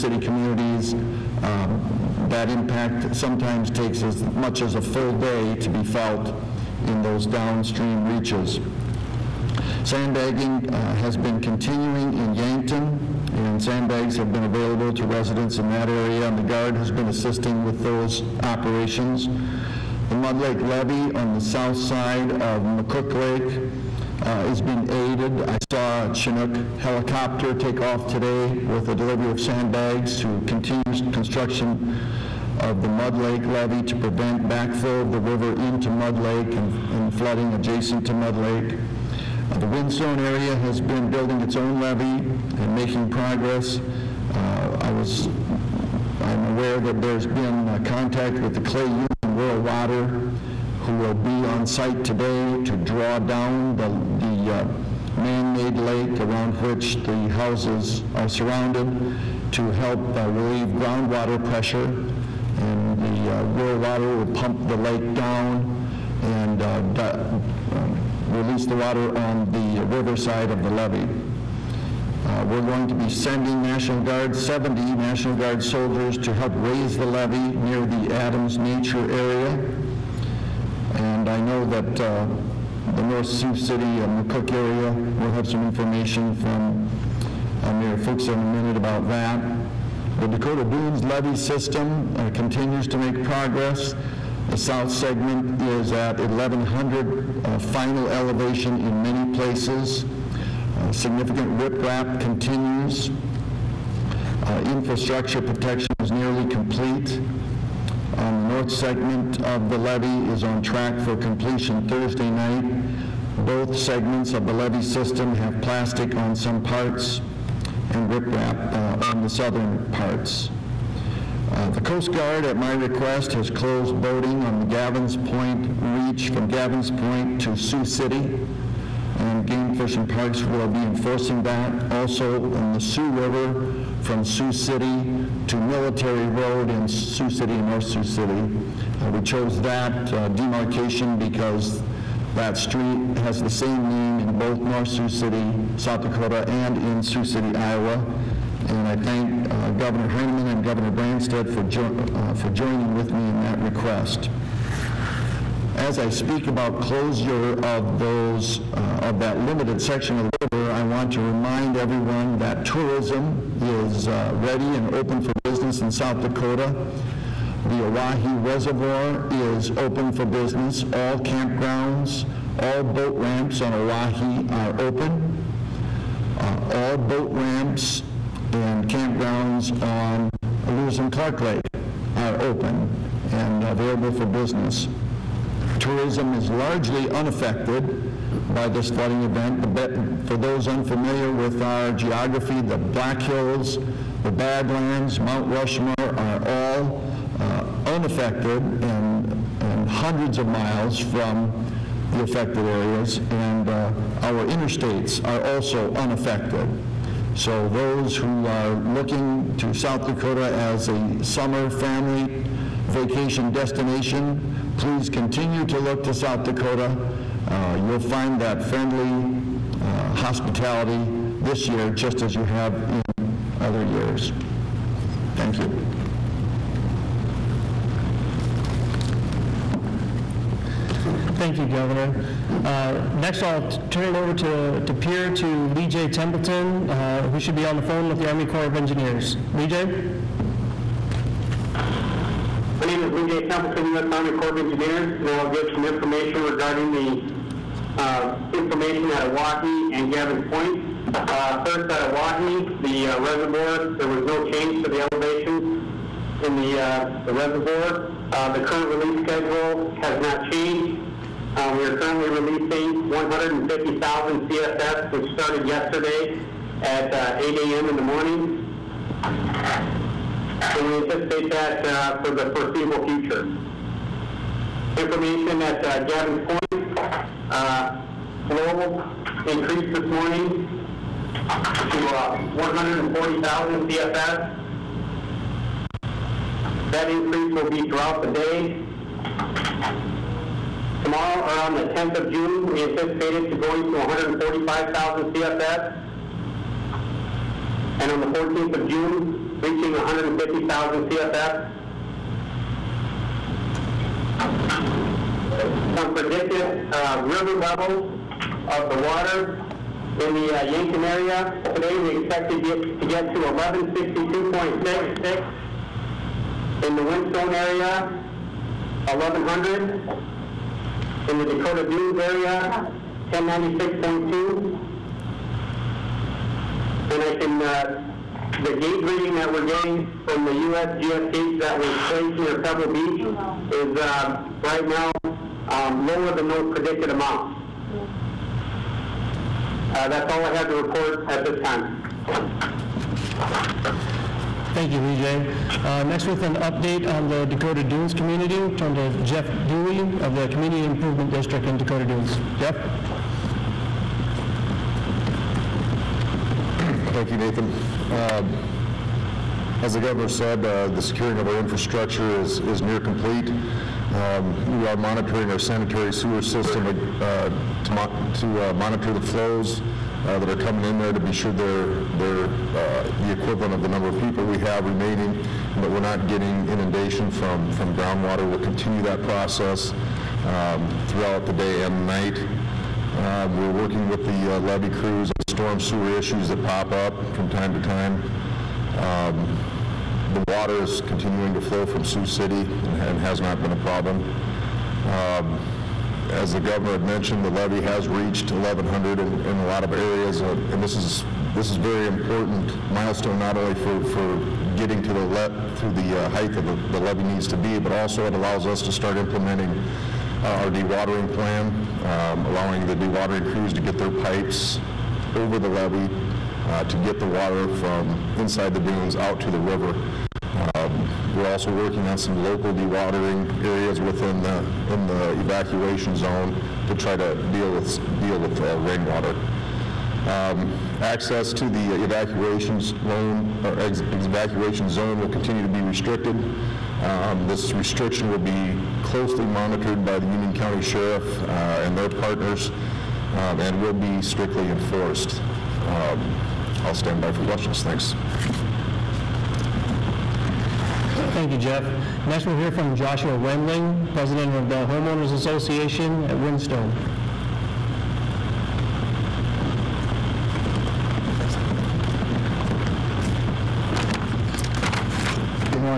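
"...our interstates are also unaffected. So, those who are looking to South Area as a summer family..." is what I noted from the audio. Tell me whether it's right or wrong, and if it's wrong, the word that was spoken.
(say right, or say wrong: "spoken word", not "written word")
wrong: "Dakota", not "Area".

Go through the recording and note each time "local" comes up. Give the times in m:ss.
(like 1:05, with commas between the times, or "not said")
7:02.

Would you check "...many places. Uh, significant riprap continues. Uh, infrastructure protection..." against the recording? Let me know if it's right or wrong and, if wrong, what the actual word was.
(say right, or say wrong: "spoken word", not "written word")
right.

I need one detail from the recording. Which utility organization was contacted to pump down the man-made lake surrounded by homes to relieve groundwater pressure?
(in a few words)
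Clay Union Rural Water.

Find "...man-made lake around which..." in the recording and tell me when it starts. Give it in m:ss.
0:55.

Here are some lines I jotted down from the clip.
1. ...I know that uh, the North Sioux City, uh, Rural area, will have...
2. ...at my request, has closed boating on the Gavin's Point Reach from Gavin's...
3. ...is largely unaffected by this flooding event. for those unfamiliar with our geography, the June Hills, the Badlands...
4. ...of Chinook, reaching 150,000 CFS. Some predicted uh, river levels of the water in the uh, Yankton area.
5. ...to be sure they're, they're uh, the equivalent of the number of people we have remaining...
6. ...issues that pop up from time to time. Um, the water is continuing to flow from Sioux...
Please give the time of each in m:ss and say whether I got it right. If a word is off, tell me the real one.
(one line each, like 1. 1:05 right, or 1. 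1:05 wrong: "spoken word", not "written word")
1. 1:21 wrong: "McCook", not "Rural"
2. 2:02 right
3. 3:06 wrong: "Black", not "June"
4. 4:58 wrong: "June", not "Chinook"
5. 6:11 right
6. 6:26 right.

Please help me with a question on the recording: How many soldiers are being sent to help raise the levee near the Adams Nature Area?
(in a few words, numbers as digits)
70.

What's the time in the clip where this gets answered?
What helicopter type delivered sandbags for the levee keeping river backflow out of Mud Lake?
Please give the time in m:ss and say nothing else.
0:26.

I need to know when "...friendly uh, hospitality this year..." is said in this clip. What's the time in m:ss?
3:38.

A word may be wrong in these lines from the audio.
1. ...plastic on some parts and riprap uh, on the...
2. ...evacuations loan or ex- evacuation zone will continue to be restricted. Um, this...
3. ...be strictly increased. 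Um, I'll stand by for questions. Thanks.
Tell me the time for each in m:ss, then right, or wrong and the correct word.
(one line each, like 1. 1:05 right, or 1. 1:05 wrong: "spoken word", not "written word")
1. 1:55 right
2. 7:11 right
3. 7:23 wrong: "enforced", not "increased".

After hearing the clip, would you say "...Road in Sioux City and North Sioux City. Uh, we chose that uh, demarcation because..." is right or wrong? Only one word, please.
right.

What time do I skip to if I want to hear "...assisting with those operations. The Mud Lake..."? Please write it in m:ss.
0:17.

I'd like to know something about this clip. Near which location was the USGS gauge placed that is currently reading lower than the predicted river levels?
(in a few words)
Pebble Beach.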